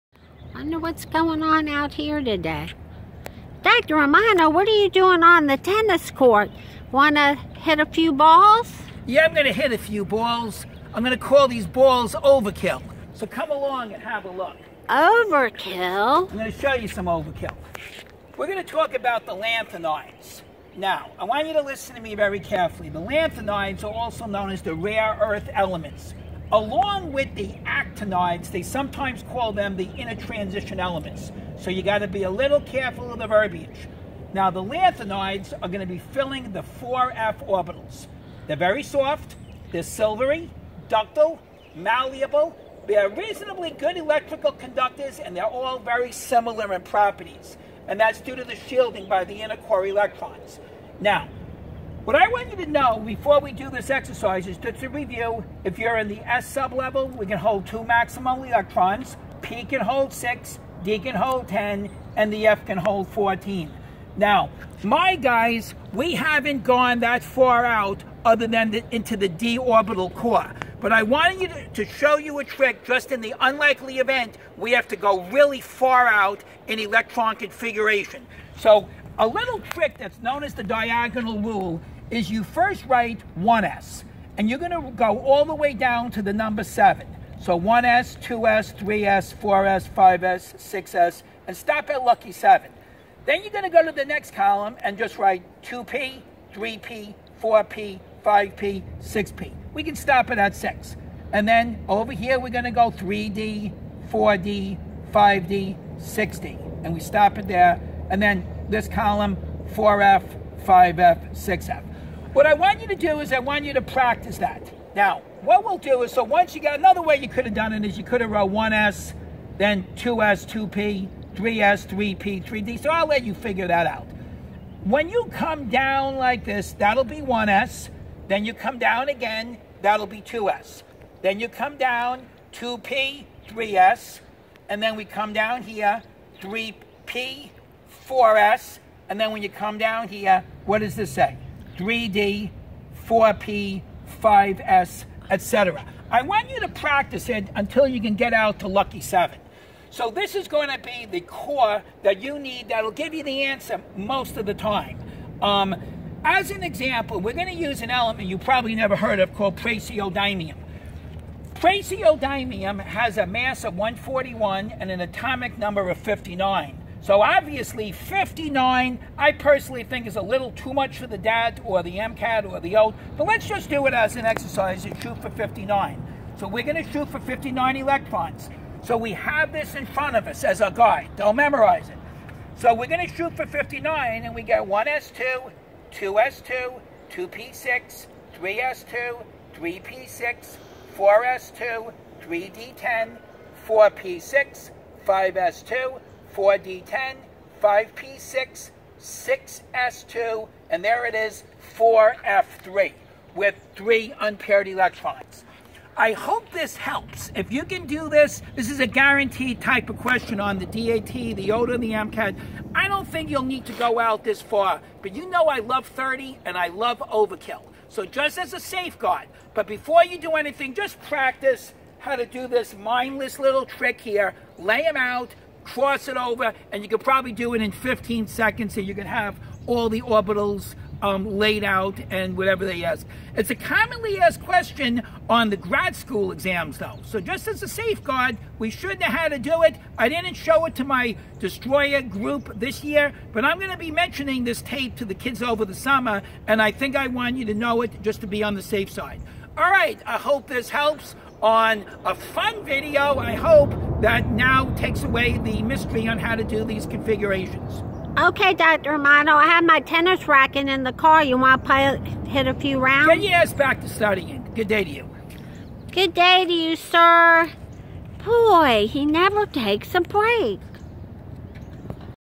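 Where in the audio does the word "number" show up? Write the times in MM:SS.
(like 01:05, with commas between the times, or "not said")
01:26, 02:45.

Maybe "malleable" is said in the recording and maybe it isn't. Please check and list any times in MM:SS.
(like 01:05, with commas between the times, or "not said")
00:41.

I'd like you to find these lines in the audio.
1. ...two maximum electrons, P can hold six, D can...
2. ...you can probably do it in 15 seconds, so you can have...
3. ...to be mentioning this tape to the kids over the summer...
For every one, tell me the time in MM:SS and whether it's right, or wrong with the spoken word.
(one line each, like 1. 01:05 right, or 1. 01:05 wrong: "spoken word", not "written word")
1. 00:57 right
2. 03:46 right
3. 04:03 right.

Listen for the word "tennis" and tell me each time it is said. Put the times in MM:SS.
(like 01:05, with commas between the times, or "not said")
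00:05, 04:19.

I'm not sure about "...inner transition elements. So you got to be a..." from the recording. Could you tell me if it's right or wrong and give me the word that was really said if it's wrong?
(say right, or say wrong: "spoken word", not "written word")
right.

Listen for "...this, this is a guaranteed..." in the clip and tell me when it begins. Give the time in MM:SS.
03:28.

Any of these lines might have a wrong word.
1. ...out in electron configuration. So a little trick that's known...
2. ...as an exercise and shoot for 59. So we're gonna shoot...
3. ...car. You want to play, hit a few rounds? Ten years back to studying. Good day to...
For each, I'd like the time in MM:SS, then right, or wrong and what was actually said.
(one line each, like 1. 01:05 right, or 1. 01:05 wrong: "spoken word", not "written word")
1. 01:16 right
2. 02:53 right
3. 04:20 right.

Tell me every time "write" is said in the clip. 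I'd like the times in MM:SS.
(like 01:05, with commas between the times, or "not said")
01:22, 01:35.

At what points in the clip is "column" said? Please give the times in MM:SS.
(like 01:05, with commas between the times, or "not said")
01:34, 01:48.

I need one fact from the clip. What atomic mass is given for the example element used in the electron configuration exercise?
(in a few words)
141.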